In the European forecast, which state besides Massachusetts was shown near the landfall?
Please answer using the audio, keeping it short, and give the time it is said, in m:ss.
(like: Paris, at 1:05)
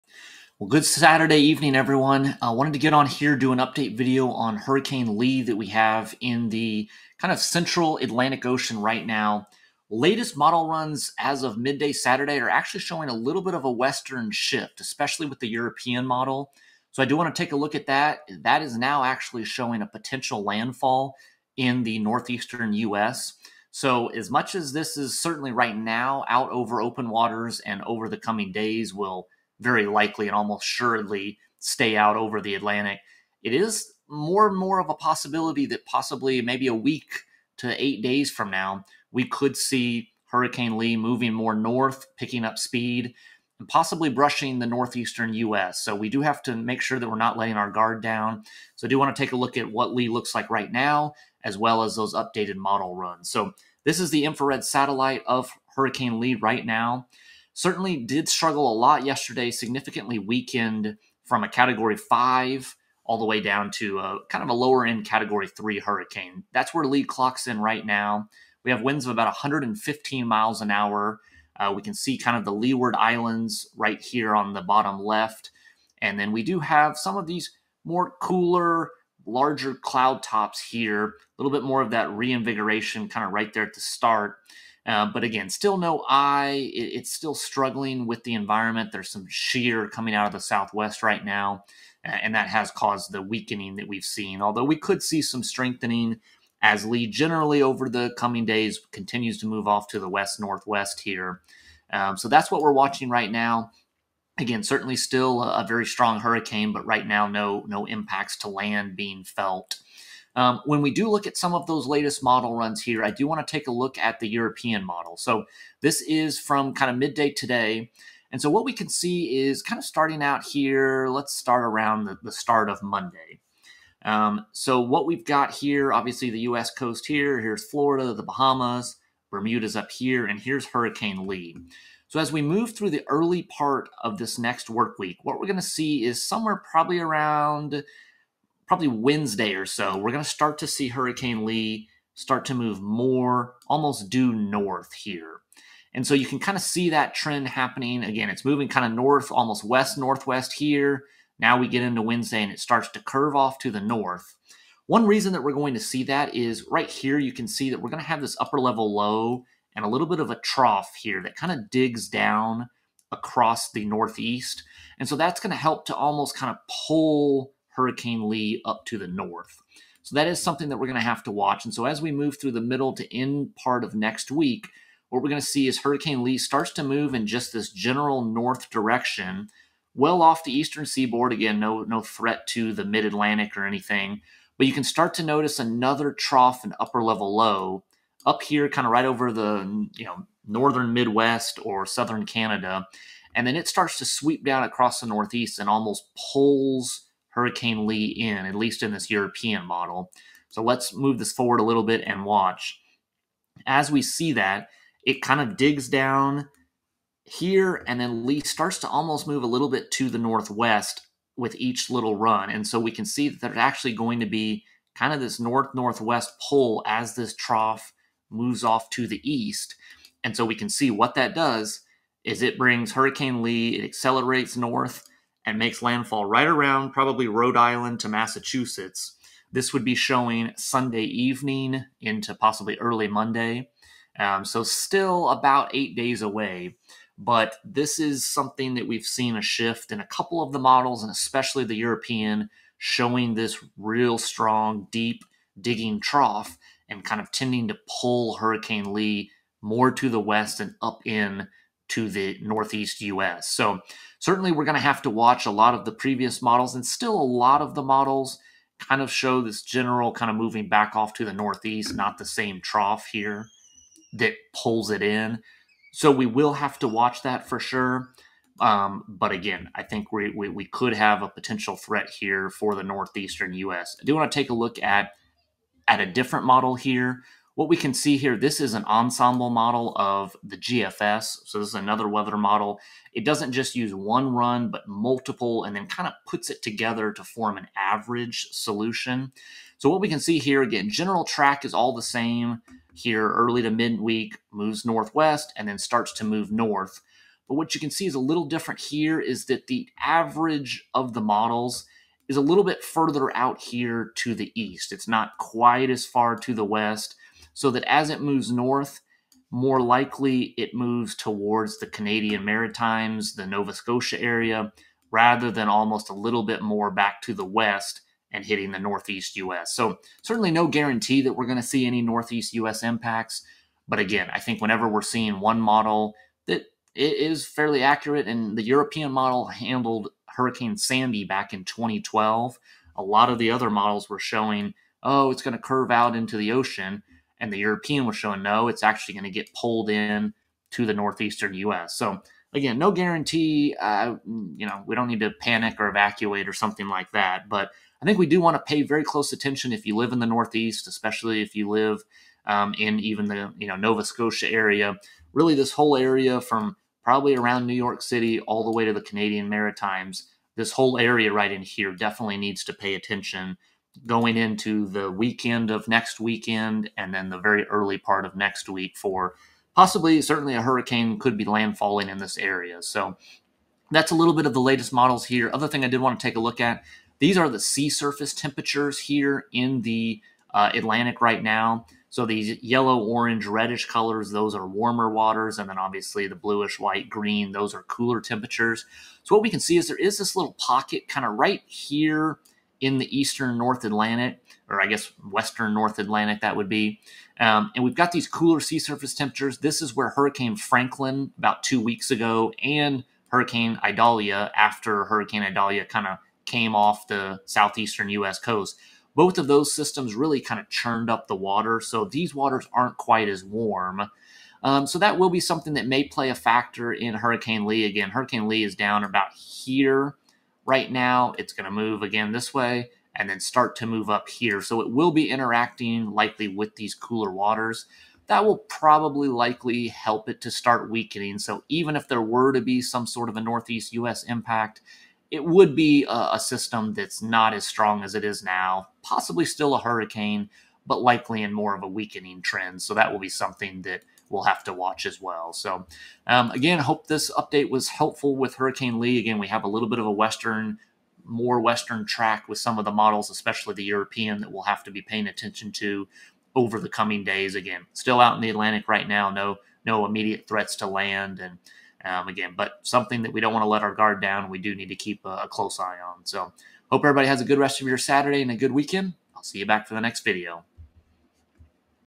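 Rhode Island, at 3:47.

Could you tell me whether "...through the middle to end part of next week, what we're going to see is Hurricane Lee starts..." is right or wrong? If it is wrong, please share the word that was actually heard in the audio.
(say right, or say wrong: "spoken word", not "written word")
right.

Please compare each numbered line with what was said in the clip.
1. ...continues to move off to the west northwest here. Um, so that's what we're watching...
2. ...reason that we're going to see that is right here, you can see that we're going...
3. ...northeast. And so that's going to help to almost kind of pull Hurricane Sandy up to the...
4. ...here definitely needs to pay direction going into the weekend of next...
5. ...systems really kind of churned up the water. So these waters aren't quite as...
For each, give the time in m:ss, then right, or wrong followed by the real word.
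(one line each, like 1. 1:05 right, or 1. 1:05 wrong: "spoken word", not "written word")
1. 1:38 right
2. 2:35 right
3. 2:43 wrong: "Lee", not "Sandy"
4. 6:01 wrong: "attention", not "direction"
5. 6:49 right.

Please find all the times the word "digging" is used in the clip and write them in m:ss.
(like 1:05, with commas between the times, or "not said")
4:05.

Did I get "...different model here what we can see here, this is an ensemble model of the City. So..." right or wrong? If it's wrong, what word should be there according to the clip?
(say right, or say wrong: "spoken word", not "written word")
wrong: "GFS", not "City".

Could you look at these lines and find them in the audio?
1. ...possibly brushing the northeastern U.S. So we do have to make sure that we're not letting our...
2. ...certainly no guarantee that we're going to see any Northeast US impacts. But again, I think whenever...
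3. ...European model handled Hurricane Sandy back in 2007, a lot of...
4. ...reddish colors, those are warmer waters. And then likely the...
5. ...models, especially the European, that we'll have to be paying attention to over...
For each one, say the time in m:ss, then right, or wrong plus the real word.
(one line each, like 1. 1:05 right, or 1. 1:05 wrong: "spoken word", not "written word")
1. 0:43 right
2. 5:20 right
3. 5:28 wrong: "2012", not "2007"
4. 6:23 wrong: "obviously", not "likely"
5. 7:32 right.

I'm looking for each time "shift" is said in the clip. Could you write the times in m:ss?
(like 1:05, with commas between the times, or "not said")
0:14, 3:59.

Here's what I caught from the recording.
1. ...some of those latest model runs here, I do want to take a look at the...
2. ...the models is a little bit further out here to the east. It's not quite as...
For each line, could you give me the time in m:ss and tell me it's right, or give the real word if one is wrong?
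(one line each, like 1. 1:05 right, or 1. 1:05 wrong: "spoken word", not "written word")
1. 1:51 right
2. 5:01 right.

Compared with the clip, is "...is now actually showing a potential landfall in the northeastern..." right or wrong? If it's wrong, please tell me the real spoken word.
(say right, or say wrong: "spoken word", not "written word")
right.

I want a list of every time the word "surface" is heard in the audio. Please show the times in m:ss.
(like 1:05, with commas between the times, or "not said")
6:17, 6:38.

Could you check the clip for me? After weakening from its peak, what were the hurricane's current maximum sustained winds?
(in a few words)
115 mph.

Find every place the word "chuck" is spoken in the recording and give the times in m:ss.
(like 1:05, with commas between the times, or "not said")
not said.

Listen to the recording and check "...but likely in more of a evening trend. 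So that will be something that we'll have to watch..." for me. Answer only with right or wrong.
wrong.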